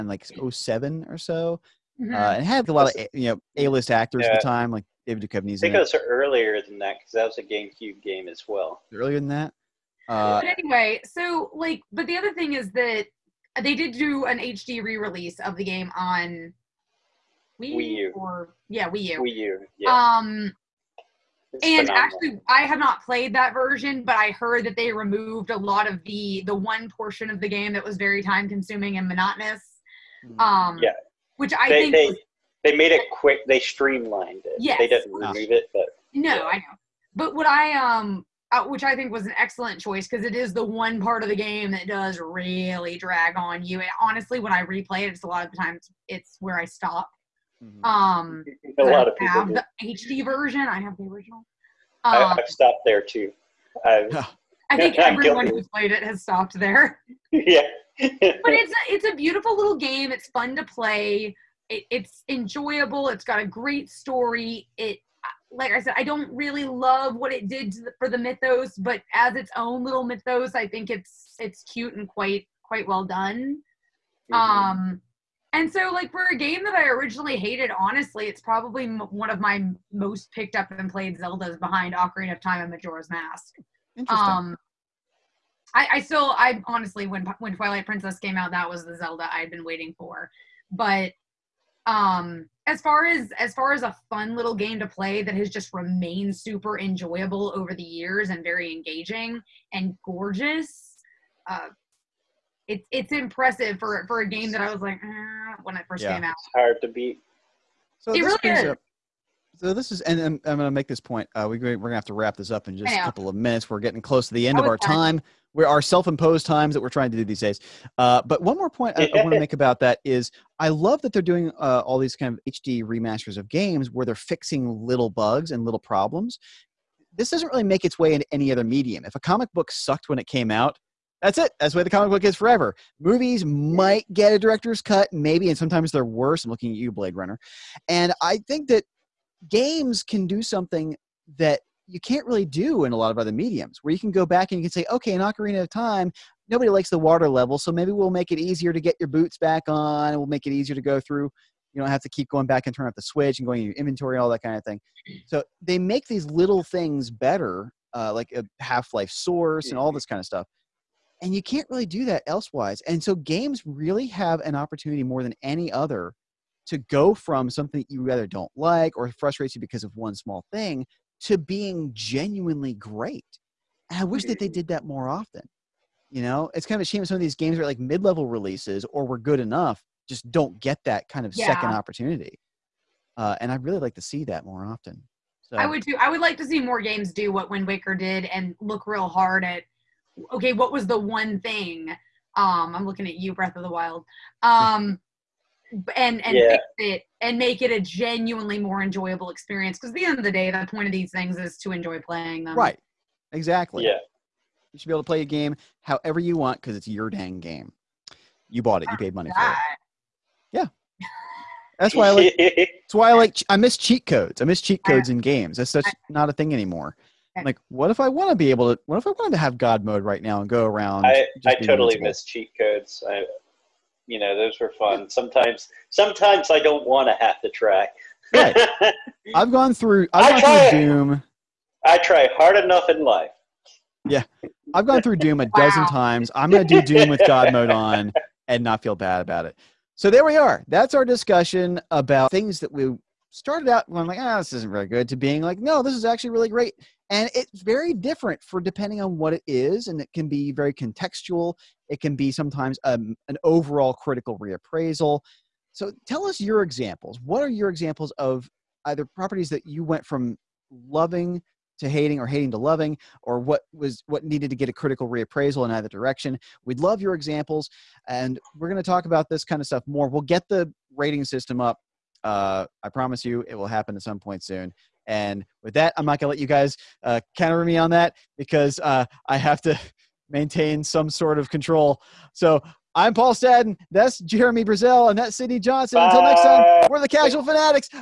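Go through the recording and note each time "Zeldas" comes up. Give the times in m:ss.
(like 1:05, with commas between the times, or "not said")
1:21, 1:28.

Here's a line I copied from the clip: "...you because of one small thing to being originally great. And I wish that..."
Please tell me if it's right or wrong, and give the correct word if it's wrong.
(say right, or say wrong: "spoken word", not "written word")
wrong: "genuinely", not "originally".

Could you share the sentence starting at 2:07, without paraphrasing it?
This doesn't really make its way into any other medium.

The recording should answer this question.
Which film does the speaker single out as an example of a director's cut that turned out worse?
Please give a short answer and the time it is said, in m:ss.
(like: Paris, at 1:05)
Blade Runner, at 2:16.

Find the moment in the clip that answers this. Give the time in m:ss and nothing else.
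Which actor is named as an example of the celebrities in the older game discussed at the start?
0:05.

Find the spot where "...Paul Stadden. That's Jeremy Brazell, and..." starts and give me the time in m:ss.
4:43.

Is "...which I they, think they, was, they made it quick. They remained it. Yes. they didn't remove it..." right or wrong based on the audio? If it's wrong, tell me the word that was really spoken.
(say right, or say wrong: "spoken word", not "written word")
wrong: "streamlined", not "remained".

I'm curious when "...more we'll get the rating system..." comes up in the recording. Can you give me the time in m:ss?
4:29.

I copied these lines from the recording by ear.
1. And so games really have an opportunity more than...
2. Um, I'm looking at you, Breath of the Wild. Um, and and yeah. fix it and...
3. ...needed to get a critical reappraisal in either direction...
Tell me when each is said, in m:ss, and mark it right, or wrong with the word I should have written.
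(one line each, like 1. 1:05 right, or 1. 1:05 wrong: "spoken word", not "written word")
1. 2:42 right
2. 3:12 right
3. 4:24 right.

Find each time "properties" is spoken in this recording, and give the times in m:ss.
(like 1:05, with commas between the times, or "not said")
4:19.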